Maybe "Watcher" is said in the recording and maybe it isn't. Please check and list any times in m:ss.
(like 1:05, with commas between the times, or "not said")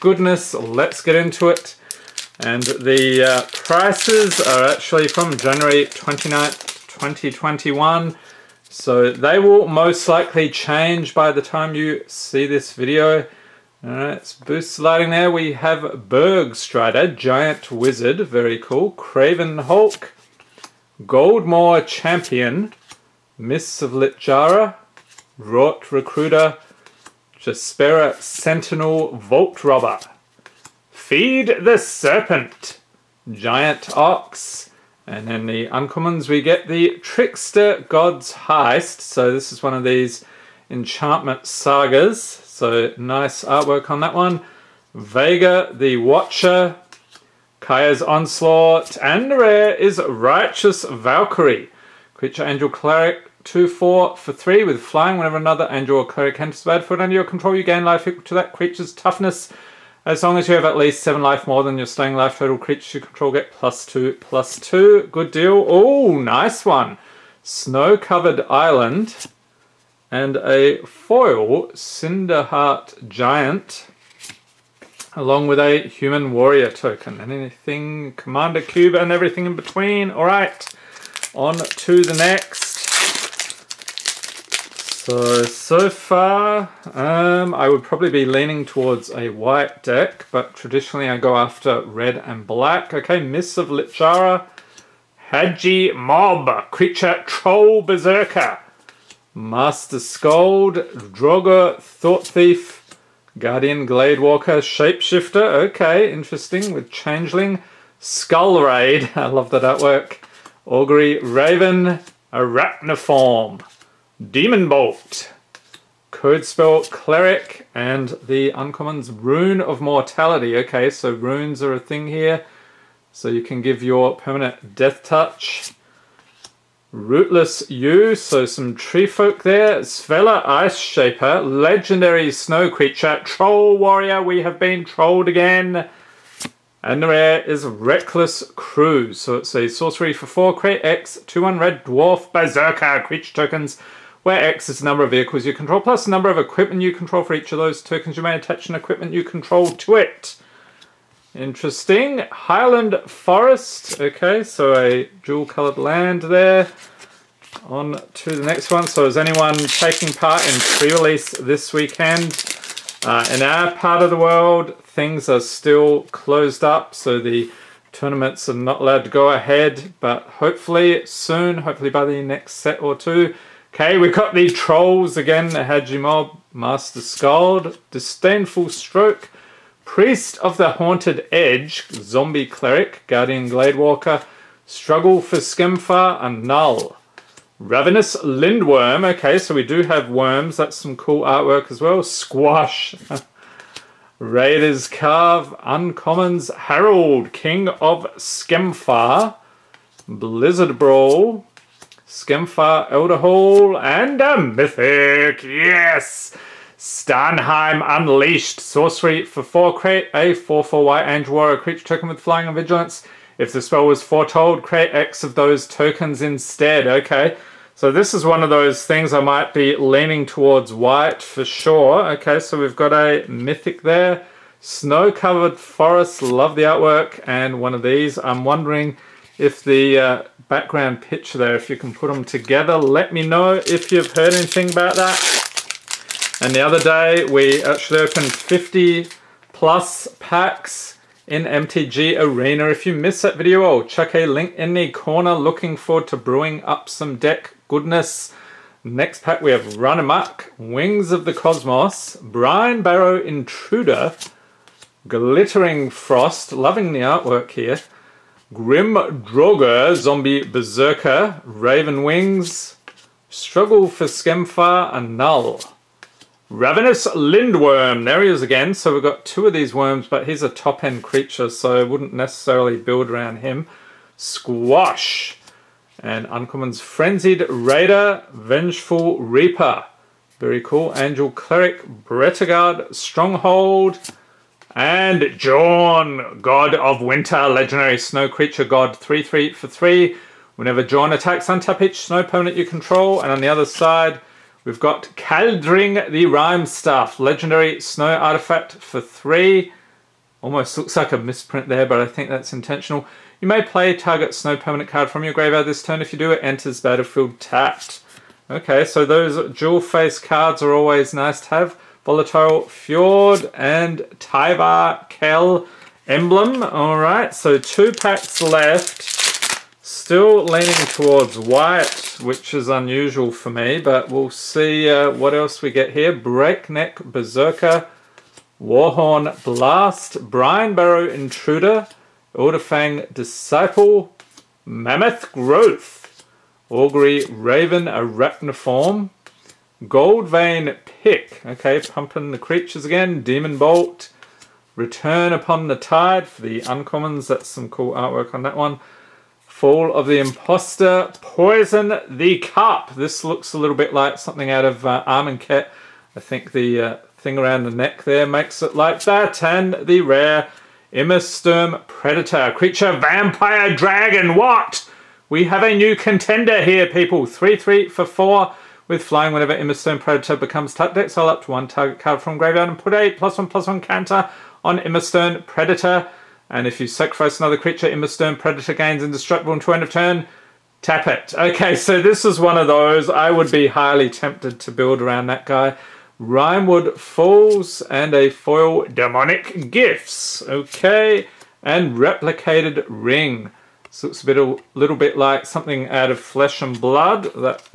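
0:45.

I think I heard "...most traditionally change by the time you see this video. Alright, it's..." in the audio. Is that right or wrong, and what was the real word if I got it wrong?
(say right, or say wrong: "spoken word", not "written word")
wrong: "likely", not "traditionally".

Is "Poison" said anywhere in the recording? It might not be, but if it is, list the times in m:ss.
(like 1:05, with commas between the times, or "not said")
5:51.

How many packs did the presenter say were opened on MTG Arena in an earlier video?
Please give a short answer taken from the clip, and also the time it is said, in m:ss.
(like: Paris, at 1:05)
50 plus, at 3:58.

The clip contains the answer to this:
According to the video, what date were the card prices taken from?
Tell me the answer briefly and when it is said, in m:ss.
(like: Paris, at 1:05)
January 29th, 2021, at 0:05.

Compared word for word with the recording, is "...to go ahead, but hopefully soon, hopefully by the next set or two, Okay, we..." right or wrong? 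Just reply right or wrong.
right.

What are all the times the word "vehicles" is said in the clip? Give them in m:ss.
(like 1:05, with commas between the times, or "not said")
2:25.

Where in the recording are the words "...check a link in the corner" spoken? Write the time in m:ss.
4:03.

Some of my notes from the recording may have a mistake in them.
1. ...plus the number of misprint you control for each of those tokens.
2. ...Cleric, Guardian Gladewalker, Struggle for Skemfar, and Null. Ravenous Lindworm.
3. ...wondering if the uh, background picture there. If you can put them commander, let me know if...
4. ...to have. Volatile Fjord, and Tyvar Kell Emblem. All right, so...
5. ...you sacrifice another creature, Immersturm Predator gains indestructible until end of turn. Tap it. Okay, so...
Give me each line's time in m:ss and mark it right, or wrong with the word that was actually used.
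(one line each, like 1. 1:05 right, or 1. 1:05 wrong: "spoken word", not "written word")
1. 2:25 wrong: "equipment", not "misprint"
2. 3:02 right
3. 3:48 wrong: "together", not "commander"
4. 5:11 right
5. 6:16 right.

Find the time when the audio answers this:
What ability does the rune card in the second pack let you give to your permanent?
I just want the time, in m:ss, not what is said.
2:04.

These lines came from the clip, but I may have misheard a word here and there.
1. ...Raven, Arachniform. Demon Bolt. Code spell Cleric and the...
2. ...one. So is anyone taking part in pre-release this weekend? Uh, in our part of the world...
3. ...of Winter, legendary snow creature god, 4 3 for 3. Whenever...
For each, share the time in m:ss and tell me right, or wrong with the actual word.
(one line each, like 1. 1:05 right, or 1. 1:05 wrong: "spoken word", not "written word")
1. 1:51 right
2. 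2:38 right
3. 4:46 wrong: "3", not "4".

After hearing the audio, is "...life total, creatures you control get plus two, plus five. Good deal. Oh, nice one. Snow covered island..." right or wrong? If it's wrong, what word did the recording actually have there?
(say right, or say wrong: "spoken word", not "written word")
wrong: "two", not "five".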